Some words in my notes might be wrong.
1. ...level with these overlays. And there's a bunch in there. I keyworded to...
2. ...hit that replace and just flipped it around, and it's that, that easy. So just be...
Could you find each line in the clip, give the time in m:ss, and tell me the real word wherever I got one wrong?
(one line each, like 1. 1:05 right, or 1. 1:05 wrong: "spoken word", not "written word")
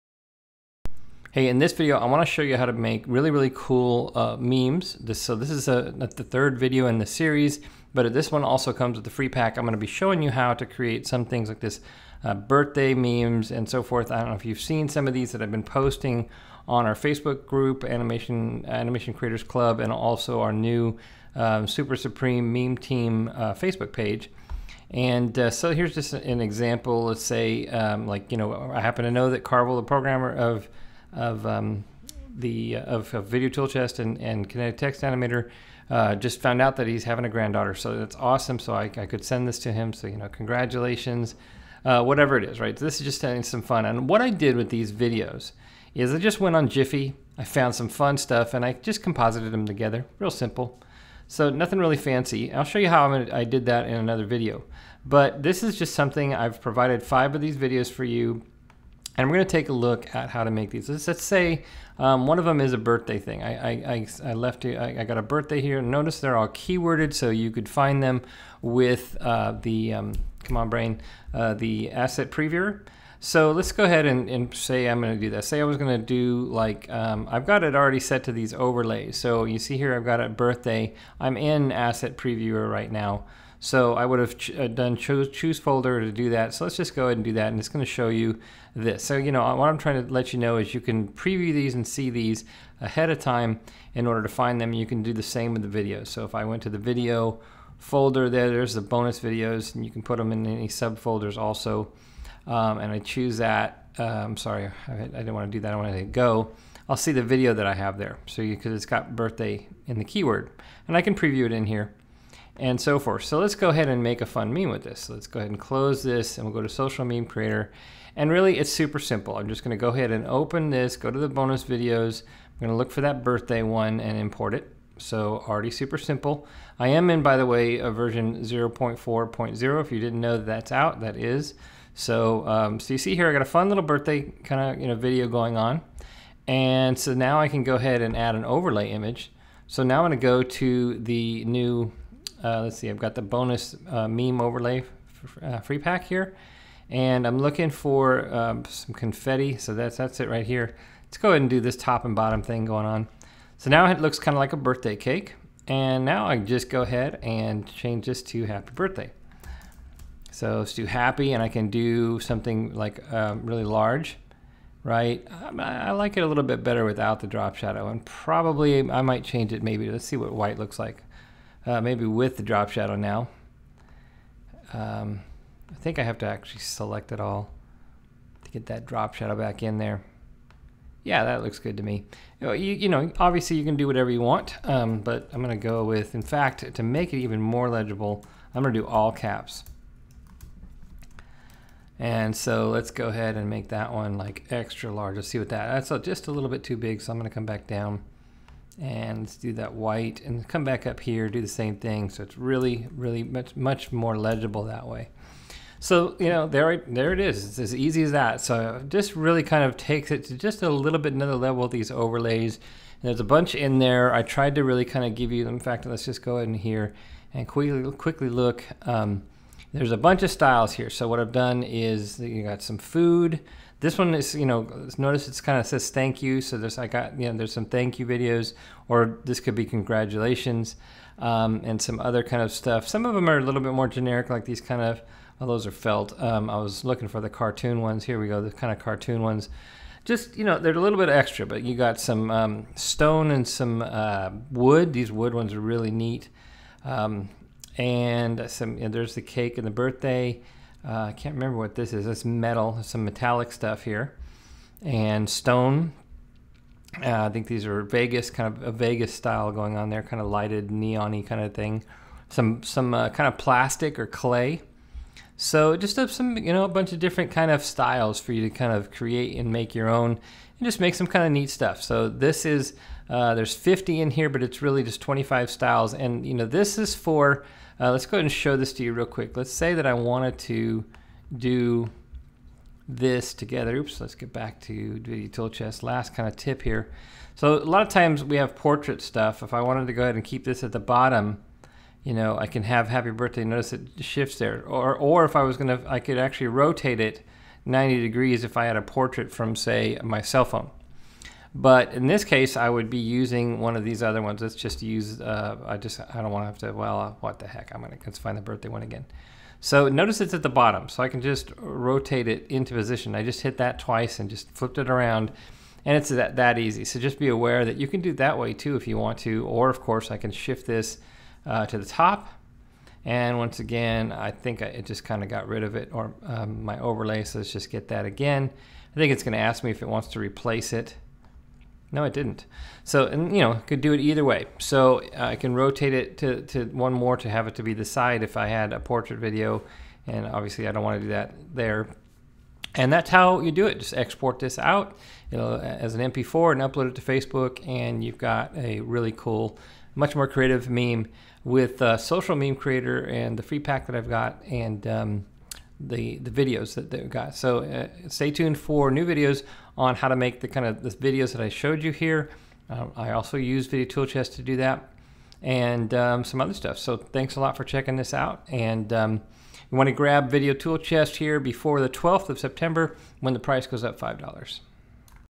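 1. 3:31 wrong: "tried", not "keyworded"
2. 5:13 wrong: "twice", not "replace".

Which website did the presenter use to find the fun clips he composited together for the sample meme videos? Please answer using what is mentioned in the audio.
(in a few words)
GIPHY.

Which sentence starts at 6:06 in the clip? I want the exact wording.
So thanks a lot for checking this out.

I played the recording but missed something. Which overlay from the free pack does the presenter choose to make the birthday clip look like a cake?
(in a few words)
confetti.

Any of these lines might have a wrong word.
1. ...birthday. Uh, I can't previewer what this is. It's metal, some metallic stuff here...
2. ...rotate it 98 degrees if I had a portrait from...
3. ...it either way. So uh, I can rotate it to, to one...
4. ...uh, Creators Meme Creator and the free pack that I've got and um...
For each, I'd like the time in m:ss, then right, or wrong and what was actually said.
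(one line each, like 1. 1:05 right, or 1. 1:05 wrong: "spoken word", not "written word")
1. 4:09 wrong: "remember", not "previewer"
2. 4:56 wrong: "90", not "98"
3. 5:33 right
4. 5:51 wrong: "Social", not "Creators".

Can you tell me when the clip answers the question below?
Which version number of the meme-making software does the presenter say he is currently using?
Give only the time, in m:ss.
2:08.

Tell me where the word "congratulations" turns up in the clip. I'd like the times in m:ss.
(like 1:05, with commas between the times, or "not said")
0:40, 3:49.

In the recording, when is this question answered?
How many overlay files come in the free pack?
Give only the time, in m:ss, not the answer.
4:33.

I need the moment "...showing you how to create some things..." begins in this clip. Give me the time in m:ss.
0:09.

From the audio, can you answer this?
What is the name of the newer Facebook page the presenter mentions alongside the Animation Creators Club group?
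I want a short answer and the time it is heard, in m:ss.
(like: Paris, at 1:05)
Super Supreme Meme Team, at 0:21.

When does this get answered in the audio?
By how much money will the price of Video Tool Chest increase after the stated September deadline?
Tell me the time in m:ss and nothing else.
6:13.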